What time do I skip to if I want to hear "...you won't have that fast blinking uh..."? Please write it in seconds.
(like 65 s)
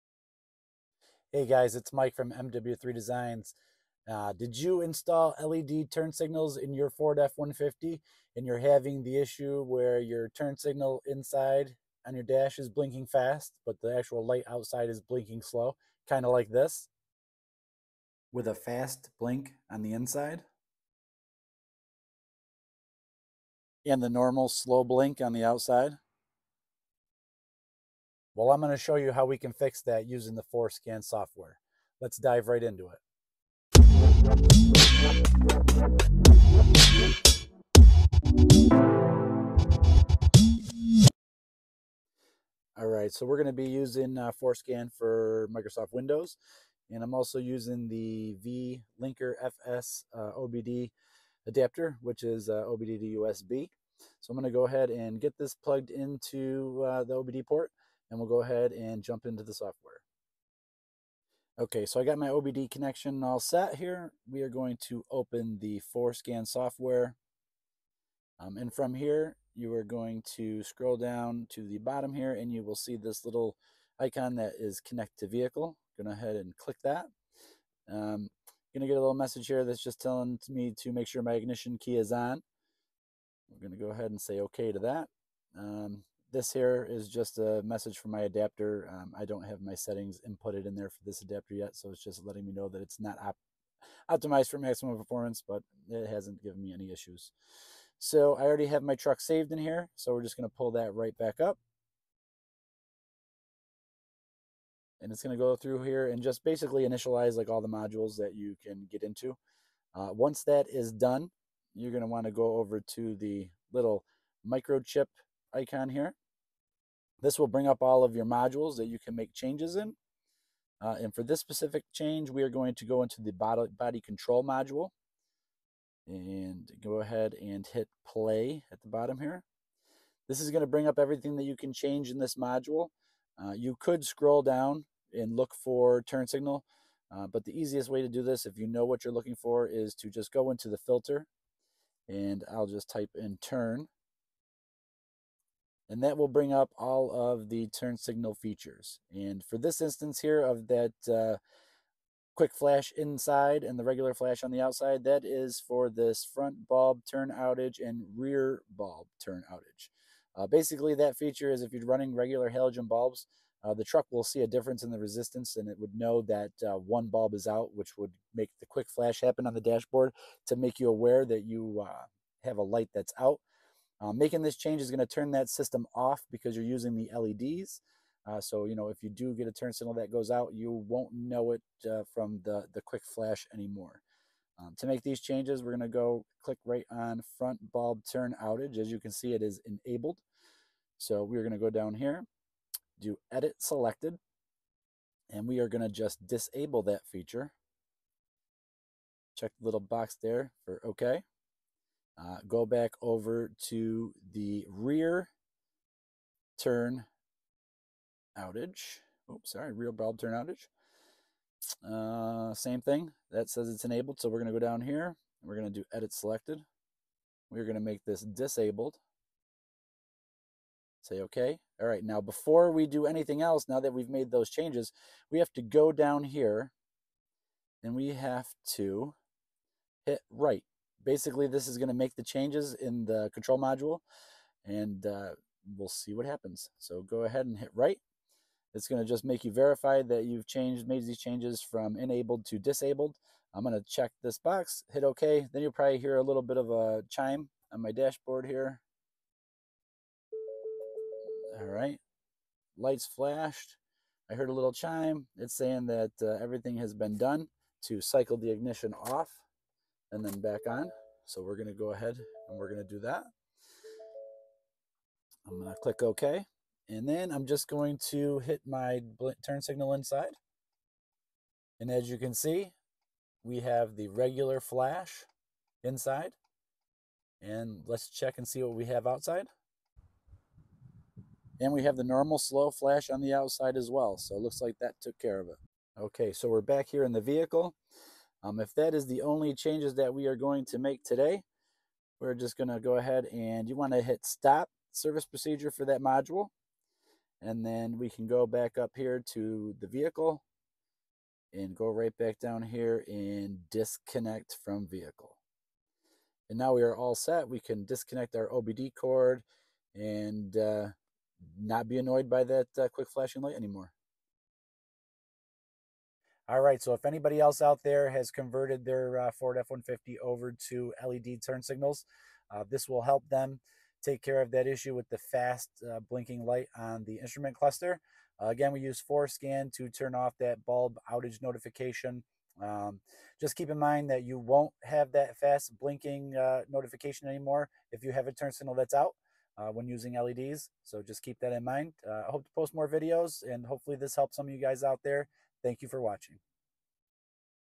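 334 s.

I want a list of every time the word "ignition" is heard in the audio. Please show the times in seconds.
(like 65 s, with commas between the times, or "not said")
81 s, 258 s.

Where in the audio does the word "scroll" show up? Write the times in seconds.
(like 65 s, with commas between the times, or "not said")
70 s, 134 s.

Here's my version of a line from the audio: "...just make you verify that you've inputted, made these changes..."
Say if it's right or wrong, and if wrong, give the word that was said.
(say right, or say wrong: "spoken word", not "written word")
wrong: "changed", not "inputted".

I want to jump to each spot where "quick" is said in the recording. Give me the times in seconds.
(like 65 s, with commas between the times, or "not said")
152 s, 168 s, 182 s, 312 s.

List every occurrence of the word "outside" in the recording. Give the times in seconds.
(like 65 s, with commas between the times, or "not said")
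14 s, 25 s, 154 s, 279 s, 283 s.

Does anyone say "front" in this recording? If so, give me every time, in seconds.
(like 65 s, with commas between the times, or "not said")
156 s, 187 s.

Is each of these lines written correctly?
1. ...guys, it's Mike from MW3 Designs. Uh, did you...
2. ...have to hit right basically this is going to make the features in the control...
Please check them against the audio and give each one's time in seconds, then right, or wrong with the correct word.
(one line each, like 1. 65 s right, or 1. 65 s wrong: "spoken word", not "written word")
1. 1 s right
2. 228 s wrong: "changes", not "features".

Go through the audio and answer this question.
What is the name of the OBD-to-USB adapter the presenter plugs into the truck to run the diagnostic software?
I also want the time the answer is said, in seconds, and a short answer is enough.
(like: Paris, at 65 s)
vLinker FS, at 48 s.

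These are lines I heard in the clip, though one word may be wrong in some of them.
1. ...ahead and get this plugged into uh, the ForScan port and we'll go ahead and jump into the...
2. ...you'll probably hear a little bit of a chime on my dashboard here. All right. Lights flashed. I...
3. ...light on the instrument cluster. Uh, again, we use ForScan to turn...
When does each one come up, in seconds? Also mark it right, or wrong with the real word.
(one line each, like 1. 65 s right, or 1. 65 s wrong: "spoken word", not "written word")
1. 54 s wrong: "OBD", not "ForScan"
2. 245 s right
3. 326 s right.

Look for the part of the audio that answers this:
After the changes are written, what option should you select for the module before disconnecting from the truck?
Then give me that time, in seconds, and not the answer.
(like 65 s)
294 s.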